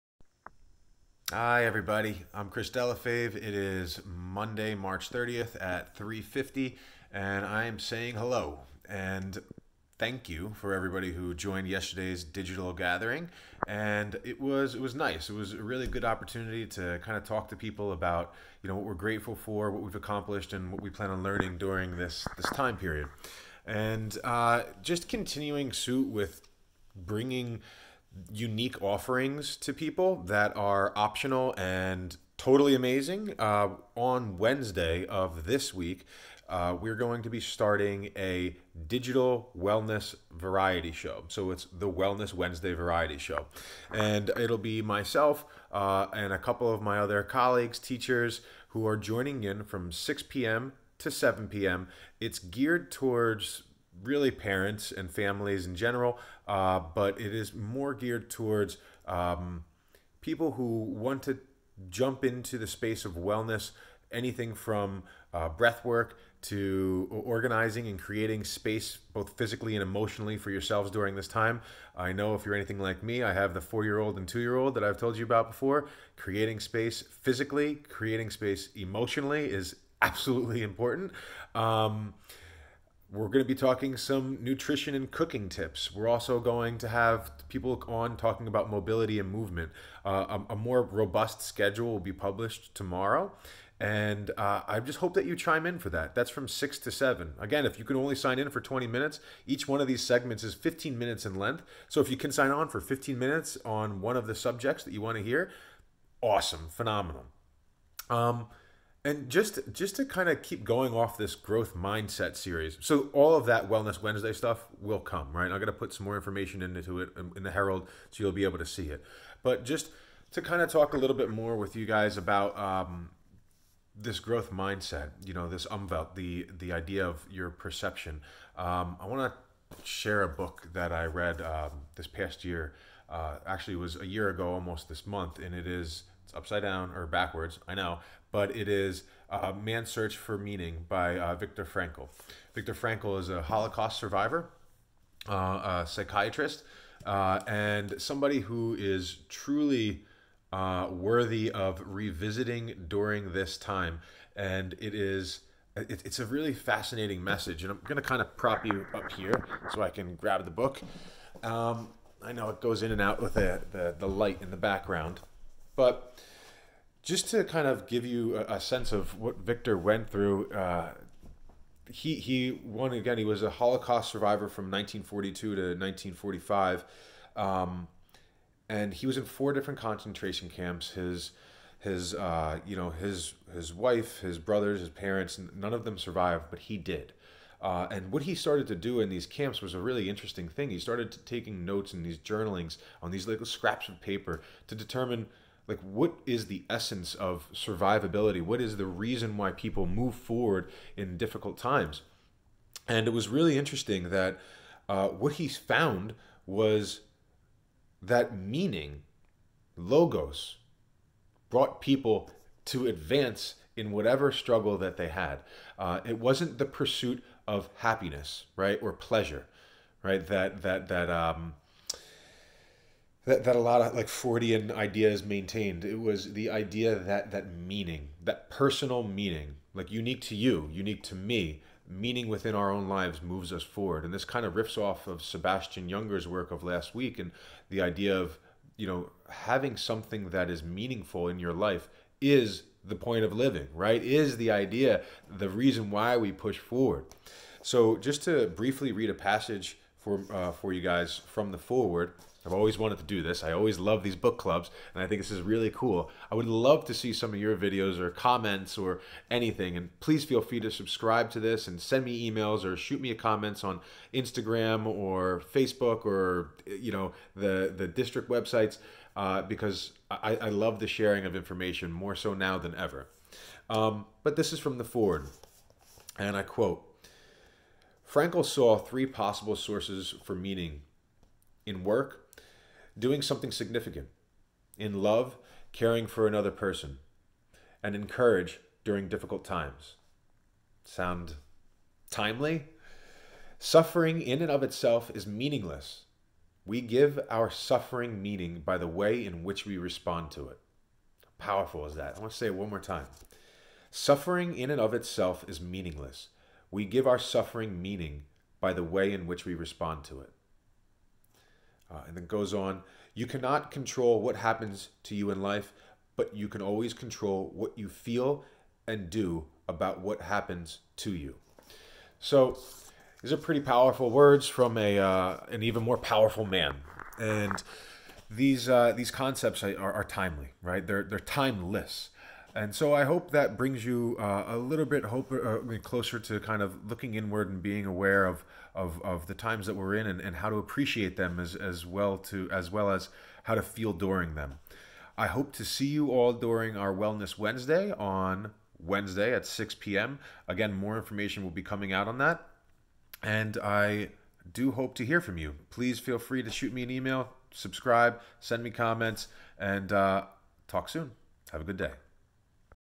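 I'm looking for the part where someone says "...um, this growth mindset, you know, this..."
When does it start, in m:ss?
2:02.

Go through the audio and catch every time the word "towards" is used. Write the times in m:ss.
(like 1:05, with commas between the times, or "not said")
0:52, 0:58.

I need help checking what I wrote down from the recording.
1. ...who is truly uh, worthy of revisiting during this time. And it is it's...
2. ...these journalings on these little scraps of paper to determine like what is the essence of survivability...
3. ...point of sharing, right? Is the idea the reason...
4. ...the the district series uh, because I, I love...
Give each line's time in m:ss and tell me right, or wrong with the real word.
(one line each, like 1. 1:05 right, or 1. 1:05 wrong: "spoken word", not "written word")
1. 2:28 right
2. 3:12 right
3. 4:02 wrong: "living", not "sharing"
4. 4:27 wrong: "websites", not "series".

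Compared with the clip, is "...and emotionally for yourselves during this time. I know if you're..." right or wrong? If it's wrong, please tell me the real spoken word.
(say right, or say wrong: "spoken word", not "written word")
right.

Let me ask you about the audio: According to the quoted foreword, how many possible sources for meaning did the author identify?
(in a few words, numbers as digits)
3.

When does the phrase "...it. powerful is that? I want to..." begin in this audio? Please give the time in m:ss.
5:00.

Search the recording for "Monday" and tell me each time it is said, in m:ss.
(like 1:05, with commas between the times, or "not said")
0:04.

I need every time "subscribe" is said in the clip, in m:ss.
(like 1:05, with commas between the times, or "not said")
4:20, 5:57.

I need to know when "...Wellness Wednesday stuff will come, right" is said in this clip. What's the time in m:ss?
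1:53.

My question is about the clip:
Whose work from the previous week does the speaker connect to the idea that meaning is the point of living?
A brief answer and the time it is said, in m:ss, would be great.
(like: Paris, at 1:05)
Sebastian Junger, at 3:55.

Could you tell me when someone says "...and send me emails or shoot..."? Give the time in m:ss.
4:21.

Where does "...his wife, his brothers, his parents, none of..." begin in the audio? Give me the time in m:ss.
3:03.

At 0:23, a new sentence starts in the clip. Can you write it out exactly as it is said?
And uh, just continuing suit with bringing unique offerings to people that are optional and totally amazing.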